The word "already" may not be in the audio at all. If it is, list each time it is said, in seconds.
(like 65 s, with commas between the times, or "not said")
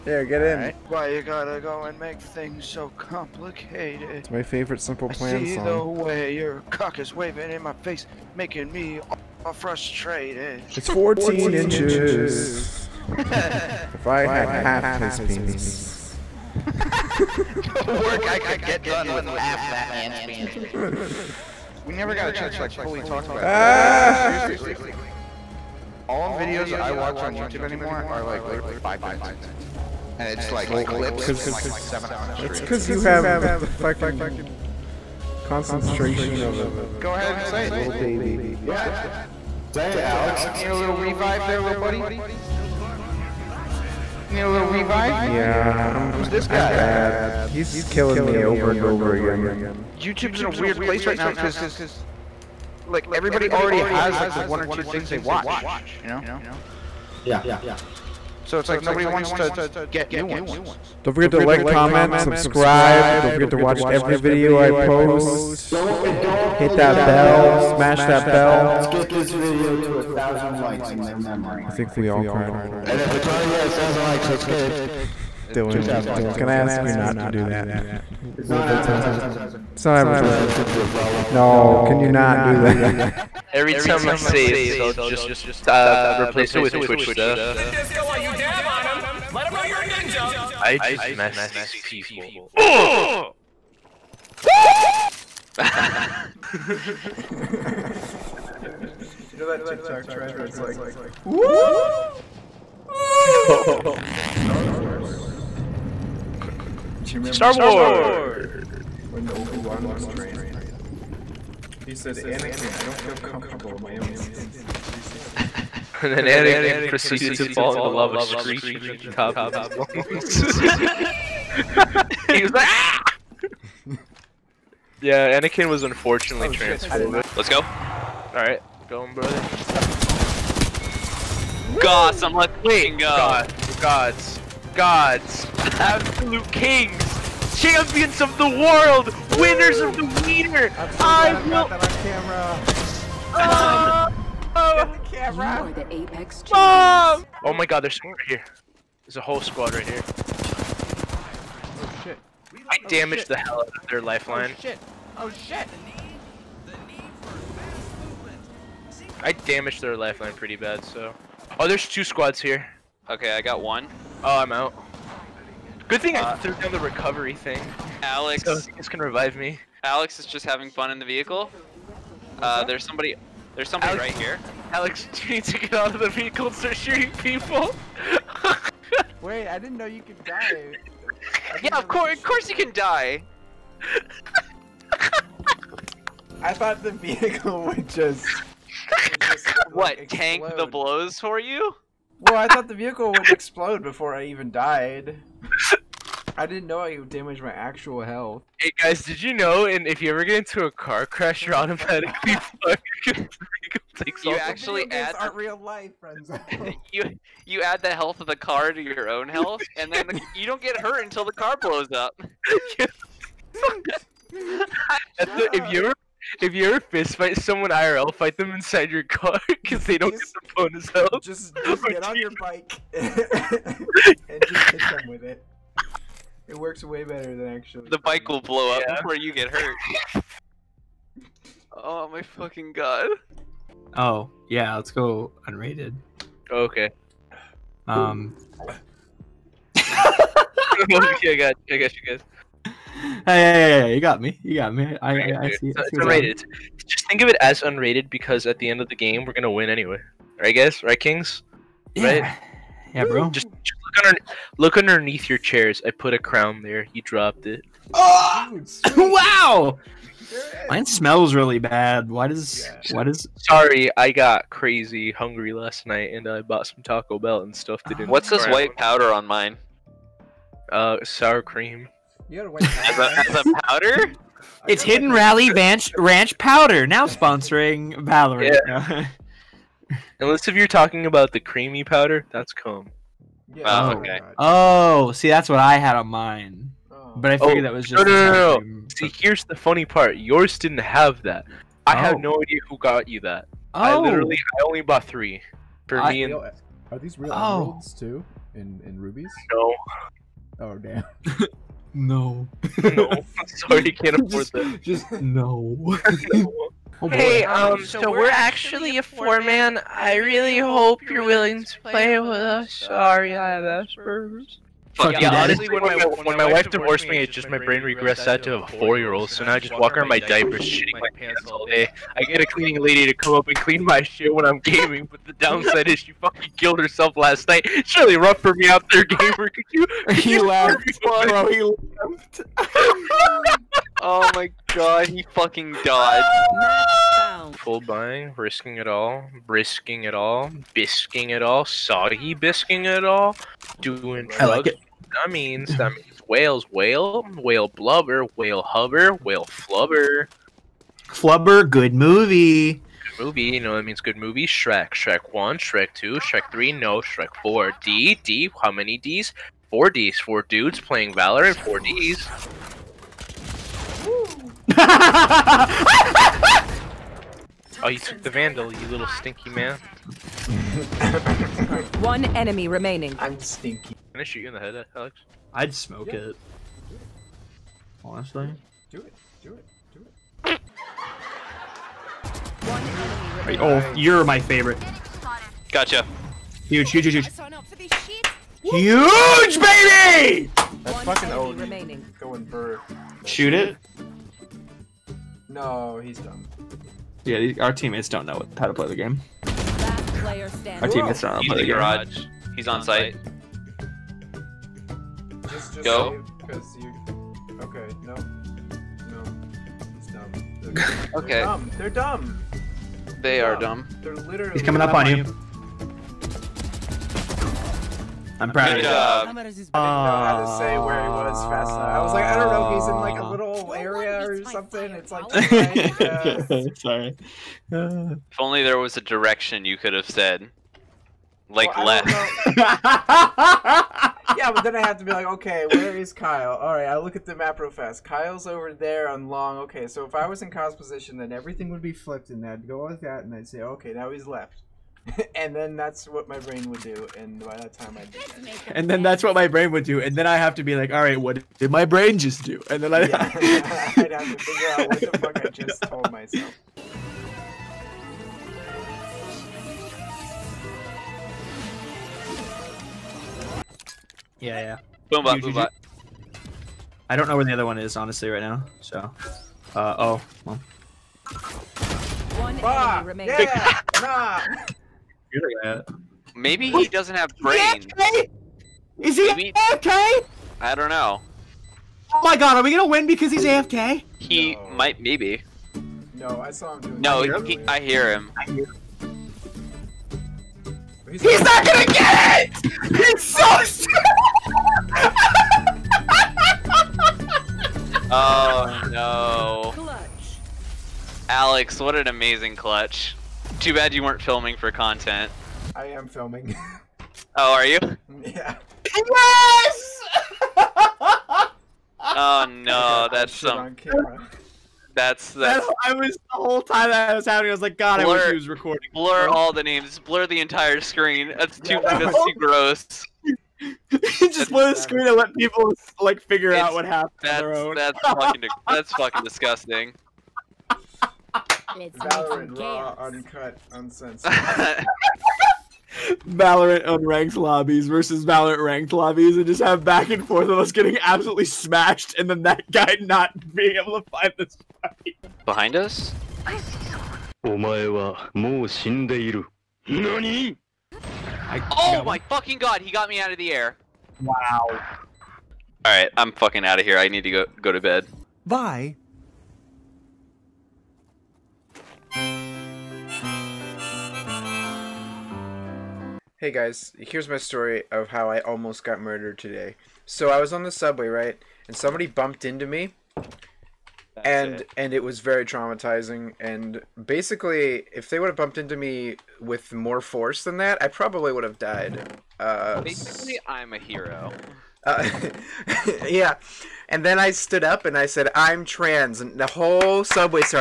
53 s, 73 s.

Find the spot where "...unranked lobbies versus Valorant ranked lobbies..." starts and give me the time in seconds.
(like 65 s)
536 s.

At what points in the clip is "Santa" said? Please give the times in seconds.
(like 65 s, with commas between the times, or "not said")
not said.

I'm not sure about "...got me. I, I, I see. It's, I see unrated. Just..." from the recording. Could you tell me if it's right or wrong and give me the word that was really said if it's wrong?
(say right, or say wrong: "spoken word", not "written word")
right.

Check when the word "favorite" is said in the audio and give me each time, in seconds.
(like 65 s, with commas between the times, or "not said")
4 s, 384 s.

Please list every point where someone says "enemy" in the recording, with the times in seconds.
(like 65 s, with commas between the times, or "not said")
372 s, 472 s.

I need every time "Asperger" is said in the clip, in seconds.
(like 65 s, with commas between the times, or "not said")
313 s.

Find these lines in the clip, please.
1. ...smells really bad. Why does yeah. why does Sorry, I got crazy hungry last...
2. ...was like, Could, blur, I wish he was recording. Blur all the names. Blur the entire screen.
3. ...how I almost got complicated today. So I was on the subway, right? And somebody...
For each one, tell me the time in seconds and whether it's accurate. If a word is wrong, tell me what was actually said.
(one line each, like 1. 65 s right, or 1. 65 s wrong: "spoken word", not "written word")
1. 260 s right
2. 517 s wrong: "God", not "Could"
3. 568 s wrong: "murdered", not "complicated".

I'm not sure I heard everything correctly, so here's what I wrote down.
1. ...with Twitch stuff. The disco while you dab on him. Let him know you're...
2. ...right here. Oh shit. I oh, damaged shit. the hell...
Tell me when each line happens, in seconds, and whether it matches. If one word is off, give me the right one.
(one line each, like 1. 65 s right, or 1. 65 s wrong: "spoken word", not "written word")
1. 86 s right
2. 149 s right.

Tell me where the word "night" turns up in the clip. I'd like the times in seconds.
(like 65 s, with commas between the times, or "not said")
265 s, 327 s.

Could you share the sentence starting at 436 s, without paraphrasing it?
All right, I look at the map real fast.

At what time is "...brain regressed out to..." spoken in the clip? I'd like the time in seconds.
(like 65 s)
317 s.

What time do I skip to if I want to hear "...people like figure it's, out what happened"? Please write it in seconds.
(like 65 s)
525 s.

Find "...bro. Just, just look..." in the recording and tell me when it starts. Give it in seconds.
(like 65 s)
253 s.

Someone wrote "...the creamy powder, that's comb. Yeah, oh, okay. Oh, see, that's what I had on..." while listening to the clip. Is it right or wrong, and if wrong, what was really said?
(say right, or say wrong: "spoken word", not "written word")
right.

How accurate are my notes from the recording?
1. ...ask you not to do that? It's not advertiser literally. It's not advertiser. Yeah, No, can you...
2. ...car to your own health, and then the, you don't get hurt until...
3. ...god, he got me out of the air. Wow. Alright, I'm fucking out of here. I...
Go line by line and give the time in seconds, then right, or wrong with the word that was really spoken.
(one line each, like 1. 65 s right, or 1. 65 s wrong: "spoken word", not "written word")
1. 76 s wrong: "friendly", not "literally"
2. 208 s right
3. 552 s right.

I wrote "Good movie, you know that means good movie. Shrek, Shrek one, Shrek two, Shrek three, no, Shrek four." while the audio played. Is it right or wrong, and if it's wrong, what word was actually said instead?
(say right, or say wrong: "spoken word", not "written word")
right.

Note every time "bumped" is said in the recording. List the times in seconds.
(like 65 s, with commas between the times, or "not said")
572 s, 578 s.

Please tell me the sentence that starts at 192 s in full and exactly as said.
Well, I thought the vehicle would explode before I even died.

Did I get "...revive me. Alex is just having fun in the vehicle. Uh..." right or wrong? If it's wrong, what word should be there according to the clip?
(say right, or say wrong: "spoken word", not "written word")
right.